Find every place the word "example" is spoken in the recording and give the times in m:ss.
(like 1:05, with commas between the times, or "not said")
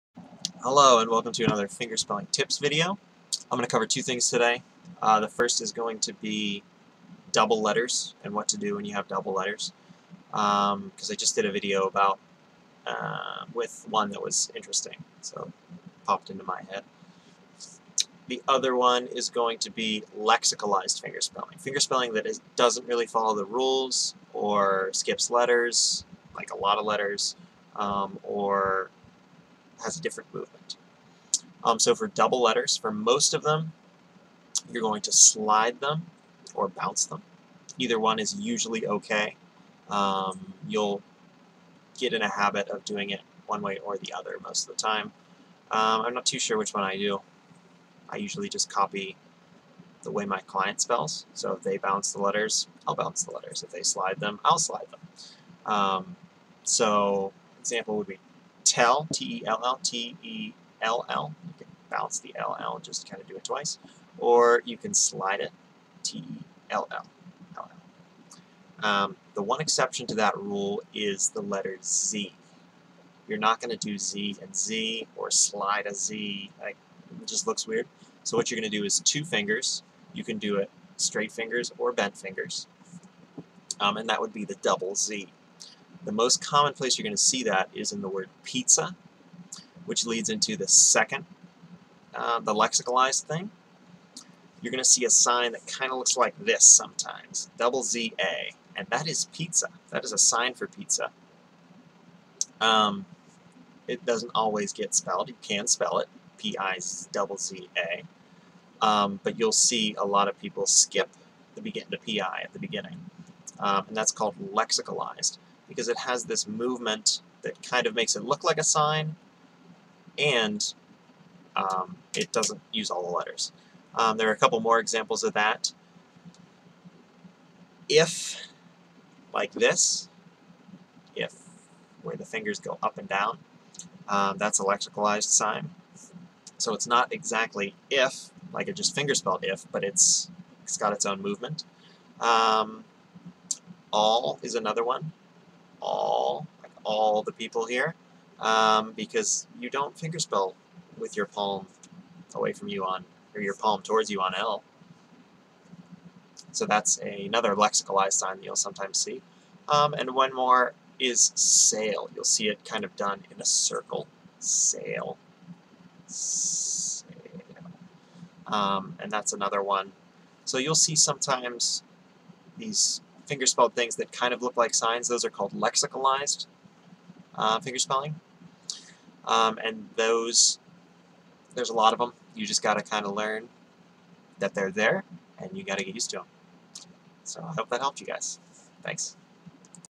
0:57, 2:04.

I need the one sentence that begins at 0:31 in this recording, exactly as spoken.
Um, so for double letters, for most of them, you're going to slide them or bounce them.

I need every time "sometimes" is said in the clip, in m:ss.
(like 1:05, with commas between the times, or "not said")
1:36, 2:38, 2:50.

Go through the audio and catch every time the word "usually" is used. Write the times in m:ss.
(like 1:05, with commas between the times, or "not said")
0:38, 0:48.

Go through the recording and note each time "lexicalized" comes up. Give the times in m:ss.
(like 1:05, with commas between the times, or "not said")
0:20, 1:32, 1:54, 2:14, 2:37, 2:55.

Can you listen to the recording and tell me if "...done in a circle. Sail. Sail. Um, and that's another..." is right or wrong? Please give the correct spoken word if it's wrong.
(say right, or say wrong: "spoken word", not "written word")
right.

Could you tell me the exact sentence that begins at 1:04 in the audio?
Or you can slide it, T-E-L-L.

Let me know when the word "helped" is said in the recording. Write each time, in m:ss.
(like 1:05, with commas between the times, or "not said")
3:07.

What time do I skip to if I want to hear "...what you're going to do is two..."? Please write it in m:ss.
1:18.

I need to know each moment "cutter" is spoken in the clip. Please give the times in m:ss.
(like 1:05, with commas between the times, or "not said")
not said.